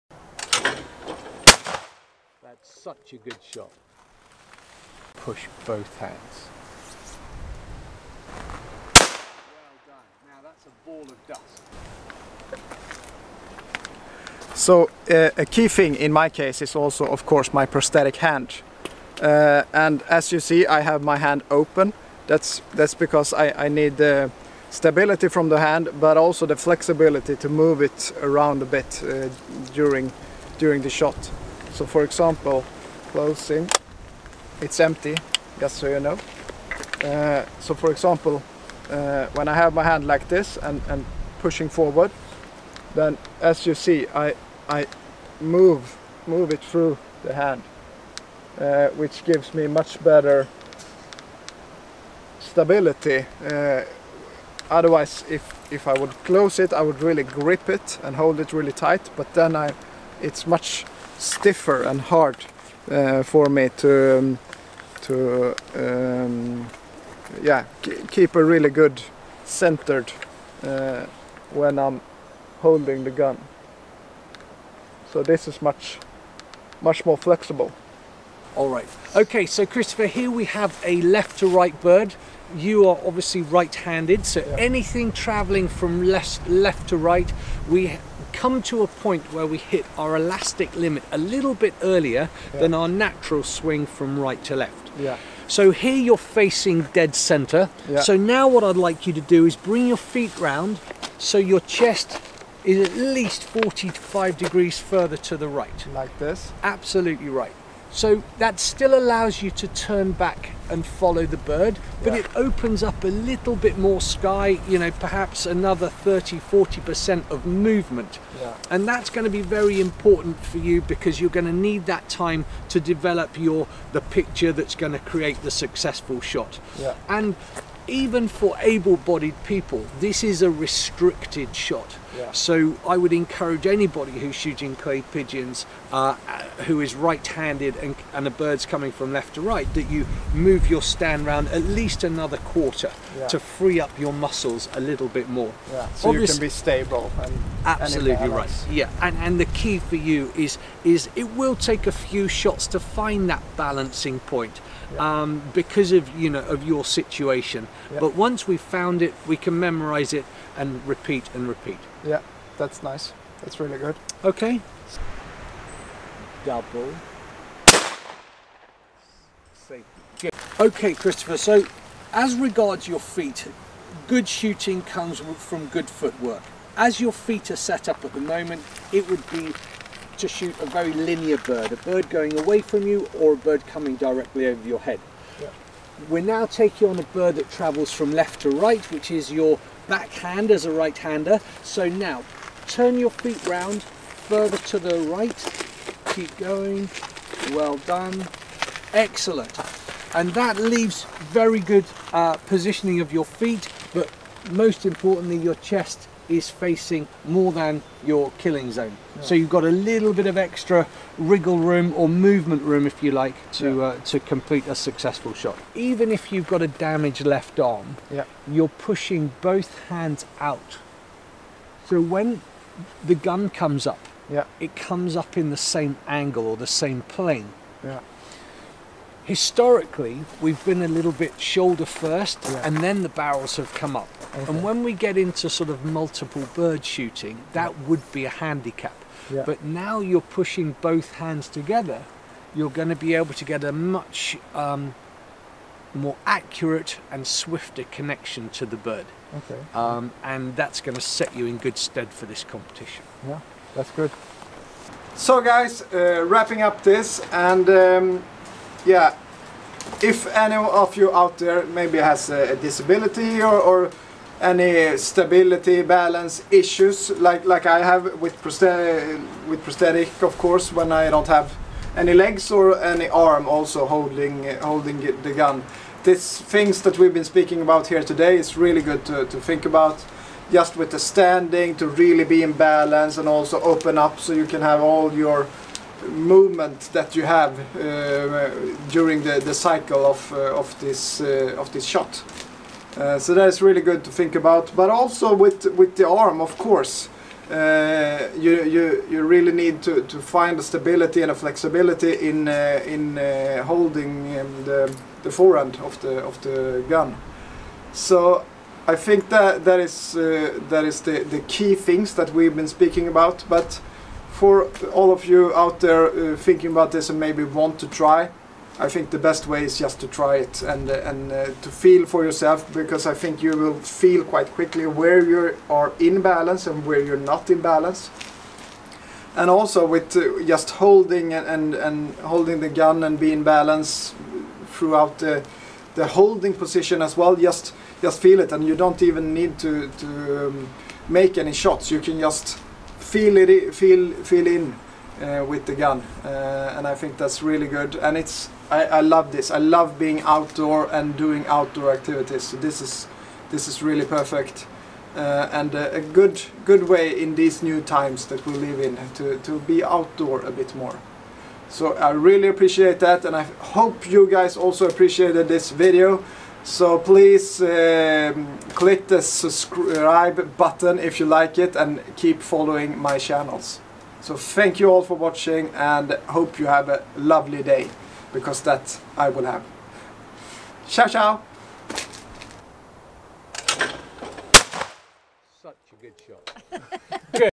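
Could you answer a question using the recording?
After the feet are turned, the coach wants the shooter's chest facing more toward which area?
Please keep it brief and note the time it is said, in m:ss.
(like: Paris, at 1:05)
Killing zone, at 3:28.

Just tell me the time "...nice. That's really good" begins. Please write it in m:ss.
2:42.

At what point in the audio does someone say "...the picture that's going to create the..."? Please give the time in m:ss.
2:03.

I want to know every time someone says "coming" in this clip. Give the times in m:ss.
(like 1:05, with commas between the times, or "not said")
2:18, 3:03.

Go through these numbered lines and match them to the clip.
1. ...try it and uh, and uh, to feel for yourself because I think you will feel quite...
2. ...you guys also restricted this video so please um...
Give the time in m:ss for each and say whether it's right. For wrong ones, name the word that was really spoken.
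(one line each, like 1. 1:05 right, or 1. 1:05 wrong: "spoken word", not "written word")
1. 5:20 right
2. 6:04 wrong: "appreciated", not "restricted".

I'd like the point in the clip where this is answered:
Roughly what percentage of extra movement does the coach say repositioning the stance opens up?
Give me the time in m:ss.
1:55.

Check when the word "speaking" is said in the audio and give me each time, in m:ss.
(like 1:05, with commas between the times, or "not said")
4:37, 5:12.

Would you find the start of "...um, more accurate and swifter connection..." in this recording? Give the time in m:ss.
4:04.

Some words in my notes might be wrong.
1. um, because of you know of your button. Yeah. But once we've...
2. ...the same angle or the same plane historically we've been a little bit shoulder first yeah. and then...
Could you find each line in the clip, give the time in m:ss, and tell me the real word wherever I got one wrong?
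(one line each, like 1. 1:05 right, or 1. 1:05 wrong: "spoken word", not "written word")
1. 2:35 wrong: "situation", not "button"
2. 3:45 right.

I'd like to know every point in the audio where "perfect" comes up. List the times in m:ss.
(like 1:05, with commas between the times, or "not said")
5:54.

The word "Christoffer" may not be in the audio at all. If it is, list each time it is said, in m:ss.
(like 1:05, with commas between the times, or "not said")
1:19, 2:50.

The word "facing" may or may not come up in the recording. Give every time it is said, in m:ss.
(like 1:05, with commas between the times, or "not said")
1:36, 3:26.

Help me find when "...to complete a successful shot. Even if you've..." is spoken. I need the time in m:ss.
3:34.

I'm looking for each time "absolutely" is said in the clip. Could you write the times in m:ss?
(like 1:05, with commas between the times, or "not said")
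1:46, 2:27.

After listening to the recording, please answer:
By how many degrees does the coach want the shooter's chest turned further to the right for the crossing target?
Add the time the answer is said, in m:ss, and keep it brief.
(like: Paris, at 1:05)
45, at 1:43.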